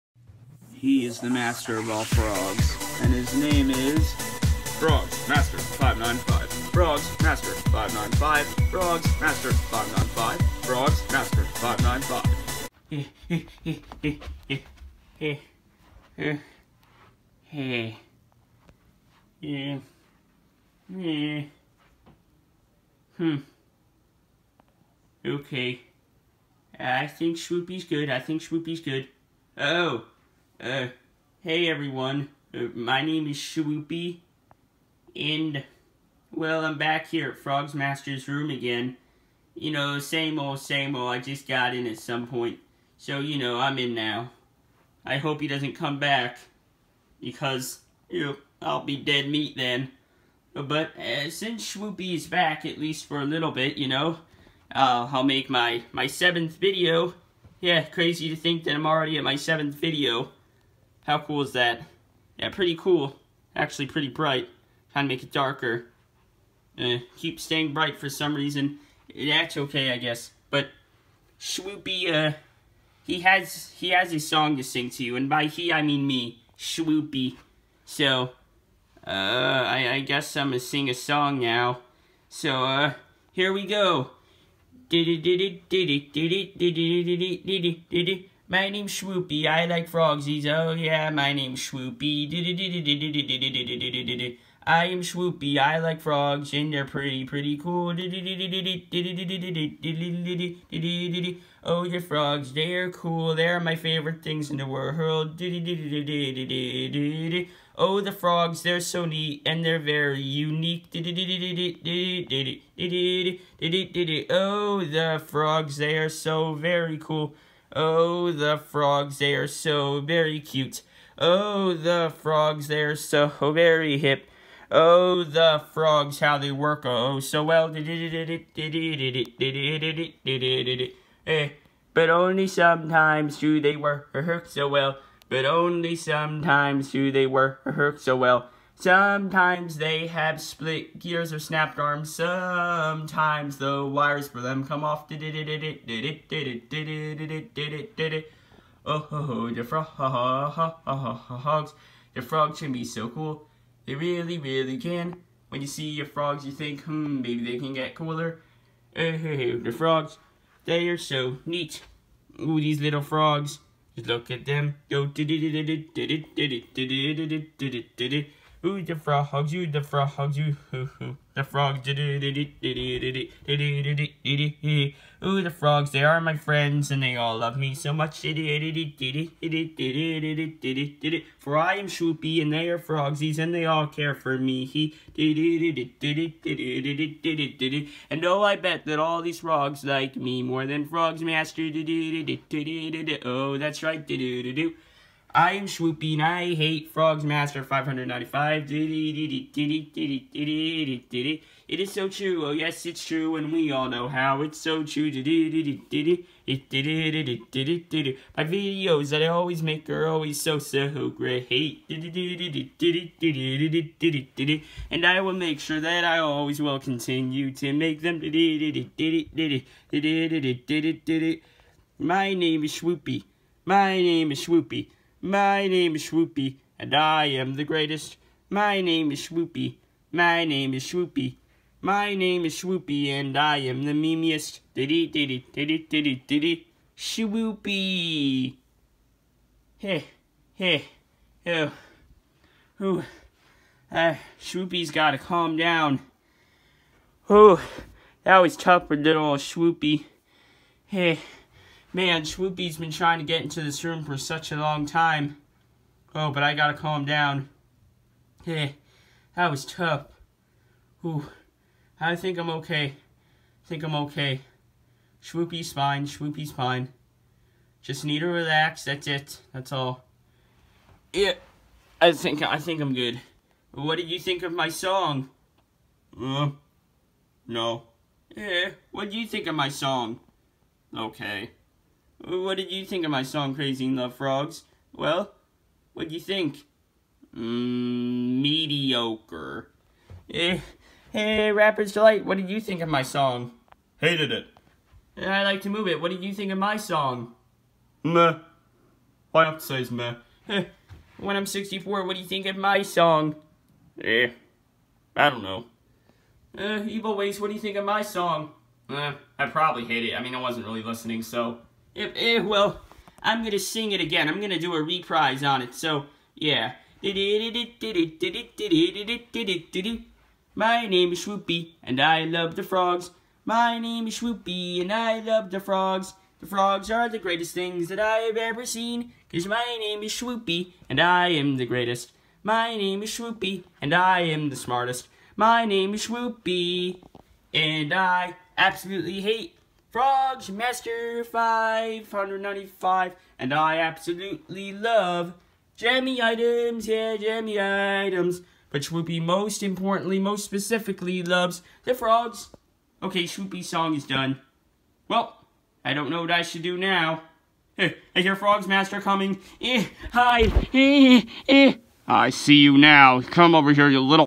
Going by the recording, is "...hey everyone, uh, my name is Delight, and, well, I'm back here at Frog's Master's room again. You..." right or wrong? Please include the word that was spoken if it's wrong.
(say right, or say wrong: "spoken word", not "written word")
wrong: "Shwoopie", not "Delight".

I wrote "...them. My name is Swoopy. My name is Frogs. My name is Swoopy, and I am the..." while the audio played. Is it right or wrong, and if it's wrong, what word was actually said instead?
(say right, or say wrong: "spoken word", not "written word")
wrong: "Swoopy", not "Frogs".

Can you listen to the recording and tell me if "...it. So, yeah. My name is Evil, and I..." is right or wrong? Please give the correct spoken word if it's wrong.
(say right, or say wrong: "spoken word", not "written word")
wrong: "Swoopy", not "Evil".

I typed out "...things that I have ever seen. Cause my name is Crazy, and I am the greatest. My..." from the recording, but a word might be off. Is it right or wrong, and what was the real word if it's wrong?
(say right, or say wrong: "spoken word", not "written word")
wrong: "Swoopy", not "Crazy".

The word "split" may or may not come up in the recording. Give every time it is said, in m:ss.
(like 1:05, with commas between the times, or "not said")
2:20.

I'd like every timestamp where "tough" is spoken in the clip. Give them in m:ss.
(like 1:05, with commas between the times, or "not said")
4:08, 4:19.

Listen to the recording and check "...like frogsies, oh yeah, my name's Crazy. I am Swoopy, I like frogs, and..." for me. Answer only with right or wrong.
wrong.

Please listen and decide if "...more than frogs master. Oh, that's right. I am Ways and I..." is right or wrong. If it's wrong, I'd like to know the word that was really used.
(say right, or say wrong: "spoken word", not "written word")
wrong: "Swoopy", not "Ways".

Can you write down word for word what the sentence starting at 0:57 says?
Yeah, crazy to think that I'm already at my seventh video.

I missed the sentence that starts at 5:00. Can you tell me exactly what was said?
Eh, when I'm 64, what do you think of my song?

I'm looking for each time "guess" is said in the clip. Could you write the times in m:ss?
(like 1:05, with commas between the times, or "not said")
1:09, 1:20.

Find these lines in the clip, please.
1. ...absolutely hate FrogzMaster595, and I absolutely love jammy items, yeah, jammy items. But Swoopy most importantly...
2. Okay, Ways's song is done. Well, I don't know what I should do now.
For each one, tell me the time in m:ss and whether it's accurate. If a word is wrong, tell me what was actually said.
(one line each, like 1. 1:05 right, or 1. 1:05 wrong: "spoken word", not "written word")
1. 5:38 right
2. 5:53 wrong: "Swoopy", not "Ways".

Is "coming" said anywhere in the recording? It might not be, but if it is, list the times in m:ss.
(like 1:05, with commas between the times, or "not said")
5:59.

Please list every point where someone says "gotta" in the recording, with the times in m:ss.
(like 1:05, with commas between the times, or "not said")
4:04, 4:16.